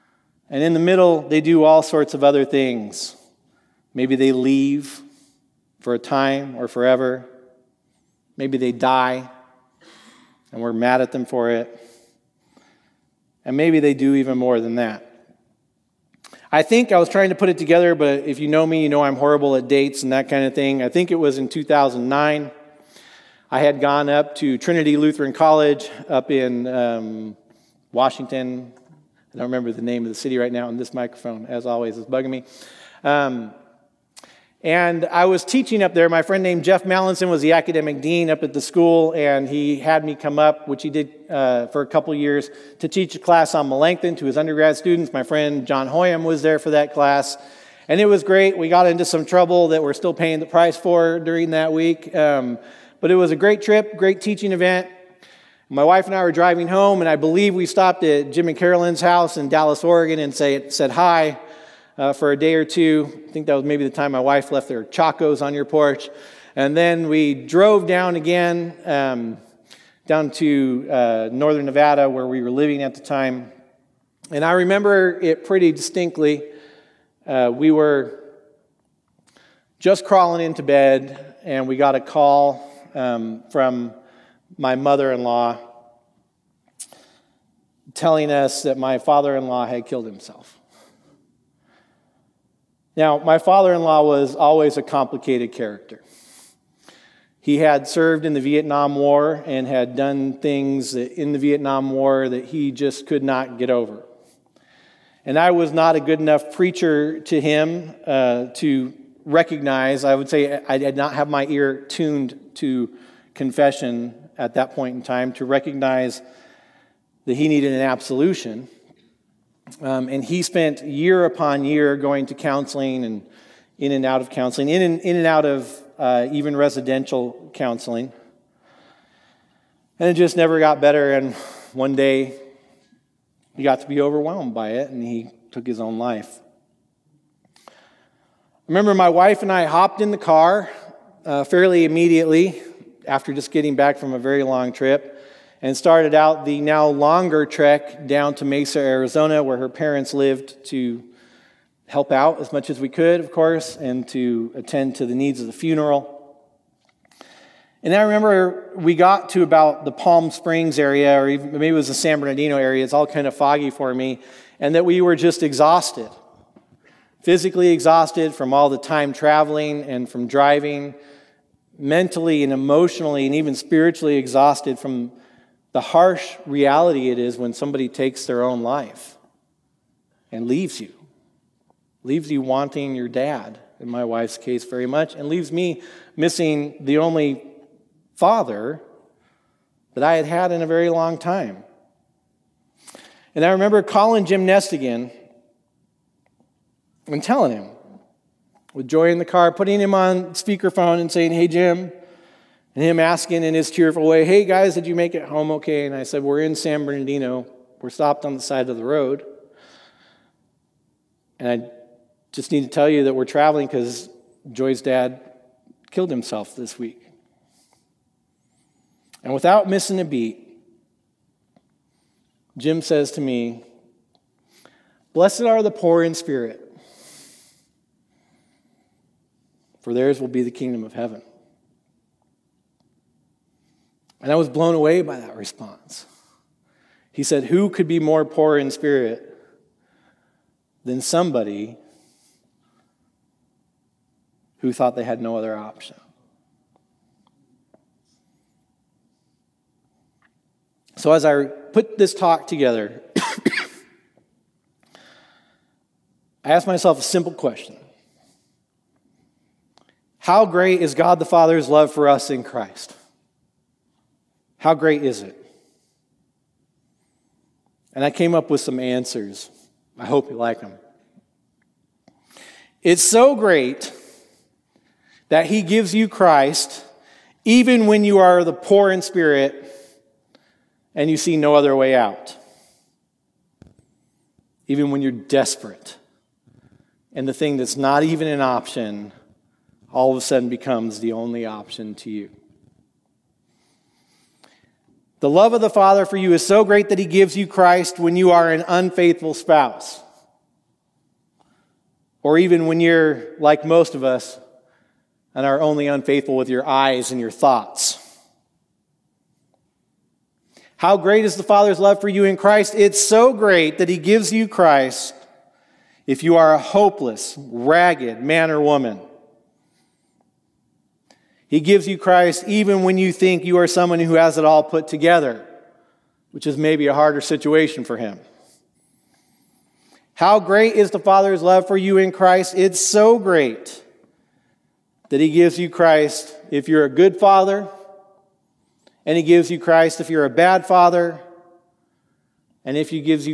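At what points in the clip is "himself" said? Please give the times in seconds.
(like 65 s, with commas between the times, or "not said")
90 s, 216 s.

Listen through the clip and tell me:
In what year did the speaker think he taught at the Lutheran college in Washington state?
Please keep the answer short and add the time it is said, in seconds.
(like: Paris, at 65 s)
2009, at 21 s.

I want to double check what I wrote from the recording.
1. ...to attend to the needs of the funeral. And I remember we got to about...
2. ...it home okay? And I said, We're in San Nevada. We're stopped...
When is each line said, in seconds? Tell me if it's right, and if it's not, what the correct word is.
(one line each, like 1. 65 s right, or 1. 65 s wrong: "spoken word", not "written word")
1. 154 s right
2. 205 s wrong: "Bernardino", not "Nevada".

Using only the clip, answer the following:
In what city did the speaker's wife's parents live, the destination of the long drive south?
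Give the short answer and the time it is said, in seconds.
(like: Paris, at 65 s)
Mesa, Arizona, at 148 s.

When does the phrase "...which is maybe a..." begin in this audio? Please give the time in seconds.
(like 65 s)
326 s.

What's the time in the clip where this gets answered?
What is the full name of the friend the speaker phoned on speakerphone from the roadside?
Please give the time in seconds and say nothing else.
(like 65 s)
194 s.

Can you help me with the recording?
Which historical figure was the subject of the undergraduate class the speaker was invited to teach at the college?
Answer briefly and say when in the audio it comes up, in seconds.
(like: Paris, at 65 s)
Melanchthon, at 43 s.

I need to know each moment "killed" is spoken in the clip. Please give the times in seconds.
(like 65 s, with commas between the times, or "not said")
89 s, 215 s.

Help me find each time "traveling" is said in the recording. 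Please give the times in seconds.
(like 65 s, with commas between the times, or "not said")
169 s, 213 s.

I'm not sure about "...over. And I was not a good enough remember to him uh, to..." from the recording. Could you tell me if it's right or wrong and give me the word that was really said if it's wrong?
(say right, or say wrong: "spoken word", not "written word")
wrong: "preacher", not "remember".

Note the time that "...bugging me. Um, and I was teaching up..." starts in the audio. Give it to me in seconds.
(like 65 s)
32 s.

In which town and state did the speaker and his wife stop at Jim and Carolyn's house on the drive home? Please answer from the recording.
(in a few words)
Dallas, Oregon.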